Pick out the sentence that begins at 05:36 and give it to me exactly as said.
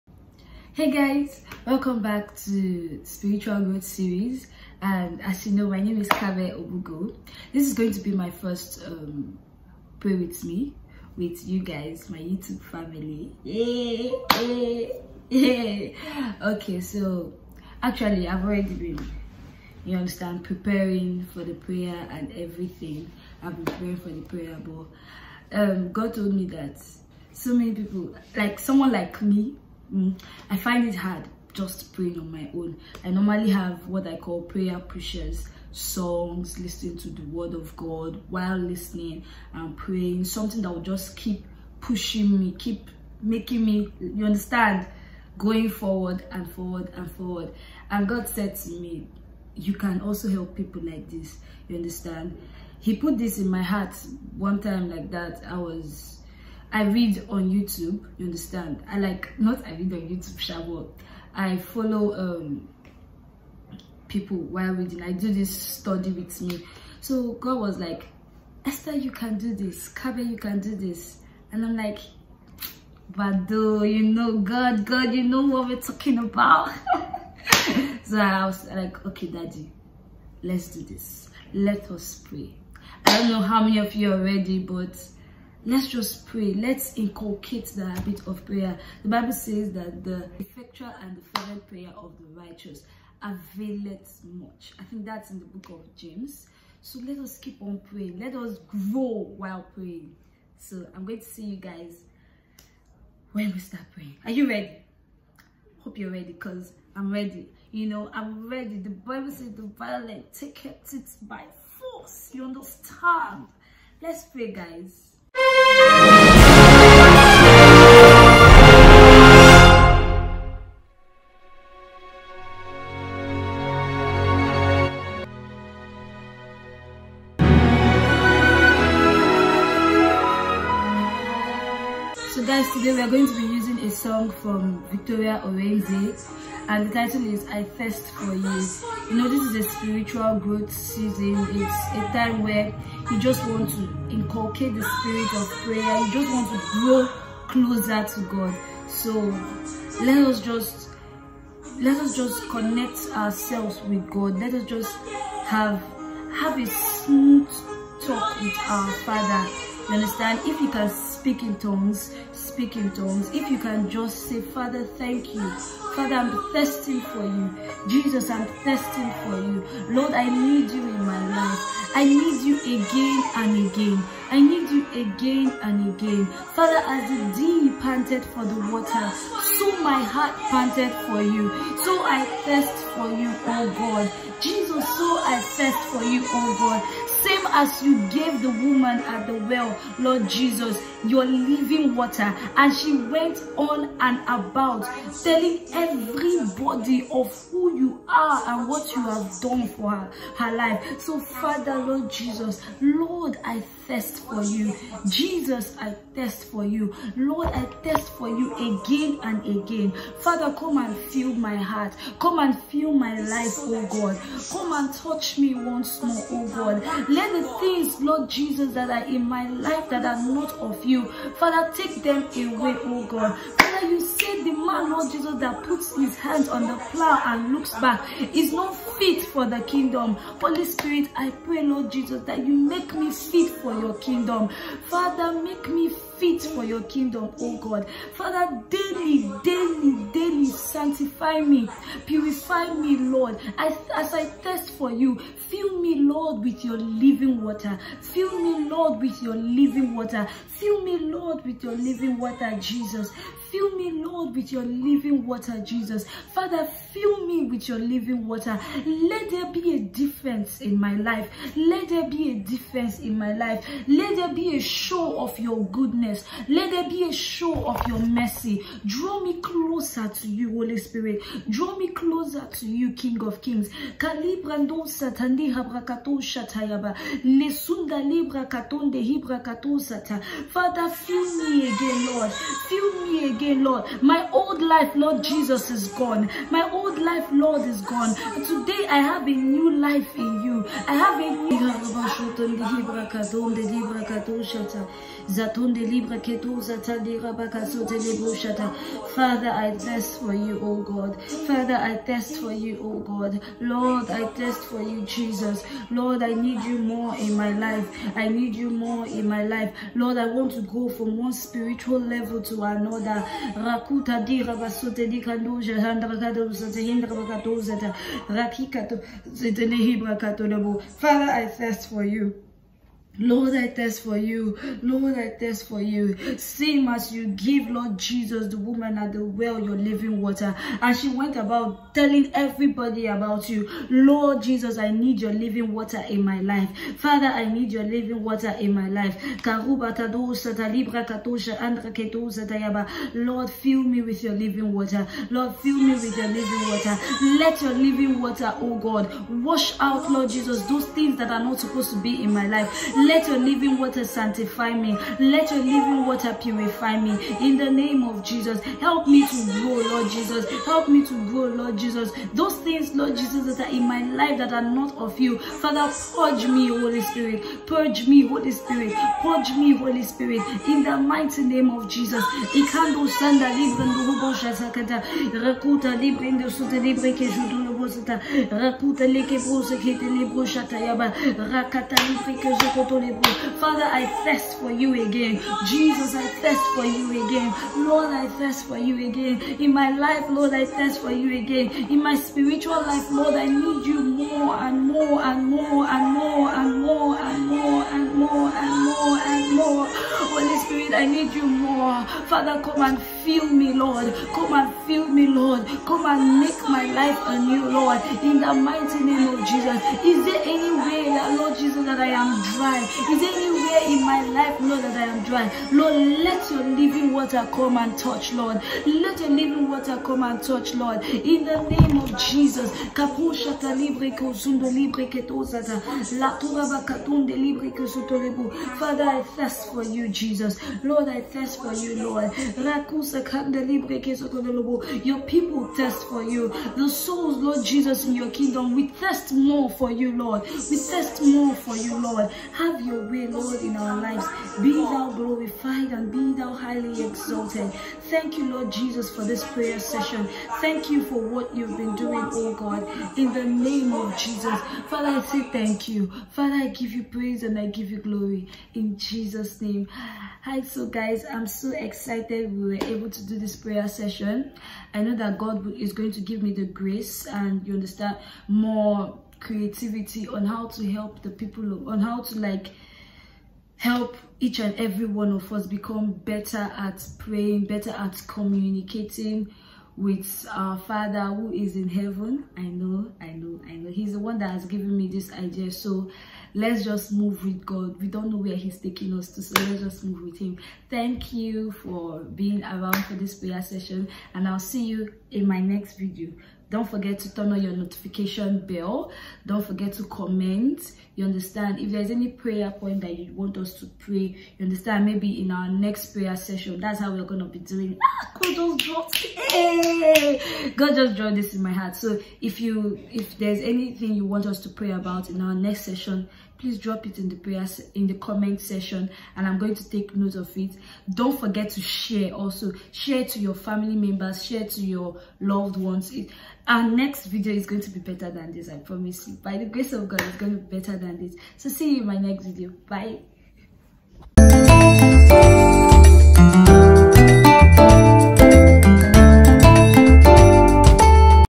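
Father, I need your living water in my life.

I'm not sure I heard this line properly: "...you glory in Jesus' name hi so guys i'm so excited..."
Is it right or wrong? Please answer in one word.
right.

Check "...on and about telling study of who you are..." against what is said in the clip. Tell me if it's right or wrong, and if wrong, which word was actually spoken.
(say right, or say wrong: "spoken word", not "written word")
wrong: "everybody", not "study".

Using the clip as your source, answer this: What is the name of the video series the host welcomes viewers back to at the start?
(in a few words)
Spiritual Growth Series.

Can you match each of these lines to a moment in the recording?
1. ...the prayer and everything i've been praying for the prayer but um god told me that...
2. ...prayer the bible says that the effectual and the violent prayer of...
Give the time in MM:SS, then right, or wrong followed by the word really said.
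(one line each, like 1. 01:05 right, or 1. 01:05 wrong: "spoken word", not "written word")
1. 00:21 right
2. 01:28 wrong: "fervent", not "violent".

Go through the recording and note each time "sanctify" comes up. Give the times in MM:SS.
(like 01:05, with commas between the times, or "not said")
04:00, 05:54.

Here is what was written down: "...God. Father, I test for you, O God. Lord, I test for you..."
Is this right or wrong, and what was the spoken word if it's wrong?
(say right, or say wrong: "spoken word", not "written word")
right.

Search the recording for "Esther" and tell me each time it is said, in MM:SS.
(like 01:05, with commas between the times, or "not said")
01:08.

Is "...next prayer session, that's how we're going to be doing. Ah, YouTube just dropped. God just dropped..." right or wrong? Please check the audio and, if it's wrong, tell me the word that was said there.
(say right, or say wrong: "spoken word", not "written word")
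wrong: "God", not "YouTube".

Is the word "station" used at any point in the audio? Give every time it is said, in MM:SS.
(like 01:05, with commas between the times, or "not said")
not said.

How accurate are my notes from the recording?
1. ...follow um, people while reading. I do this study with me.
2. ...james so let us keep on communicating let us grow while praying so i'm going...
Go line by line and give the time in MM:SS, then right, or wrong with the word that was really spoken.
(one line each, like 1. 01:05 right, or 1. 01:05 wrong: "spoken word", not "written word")
1. 01:01 right
2. 01:35 wrong: "praying", not "communicating".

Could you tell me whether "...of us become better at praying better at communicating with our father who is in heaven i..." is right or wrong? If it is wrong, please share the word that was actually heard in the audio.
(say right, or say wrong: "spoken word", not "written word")
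right.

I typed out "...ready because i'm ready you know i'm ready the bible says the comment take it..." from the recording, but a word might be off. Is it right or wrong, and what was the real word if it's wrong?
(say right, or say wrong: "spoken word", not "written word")
wrong: "violent", not "comment".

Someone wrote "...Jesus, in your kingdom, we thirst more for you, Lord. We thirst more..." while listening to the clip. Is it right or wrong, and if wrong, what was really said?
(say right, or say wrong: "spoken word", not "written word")
right.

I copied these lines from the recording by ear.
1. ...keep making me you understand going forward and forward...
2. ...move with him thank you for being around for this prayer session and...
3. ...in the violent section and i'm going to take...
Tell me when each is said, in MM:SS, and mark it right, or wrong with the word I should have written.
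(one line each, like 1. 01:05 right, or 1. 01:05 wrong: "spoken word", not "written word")
1. 00:42 right
2. 08:10 right
3. 08:37 wrong: "comment", not "violent".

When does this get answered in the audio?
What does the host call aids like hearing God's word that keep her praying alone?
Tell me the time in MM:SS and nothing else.
00:34.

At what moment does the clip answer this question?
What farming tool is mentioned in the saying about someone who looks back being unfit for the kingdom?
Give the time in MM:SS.
03:46.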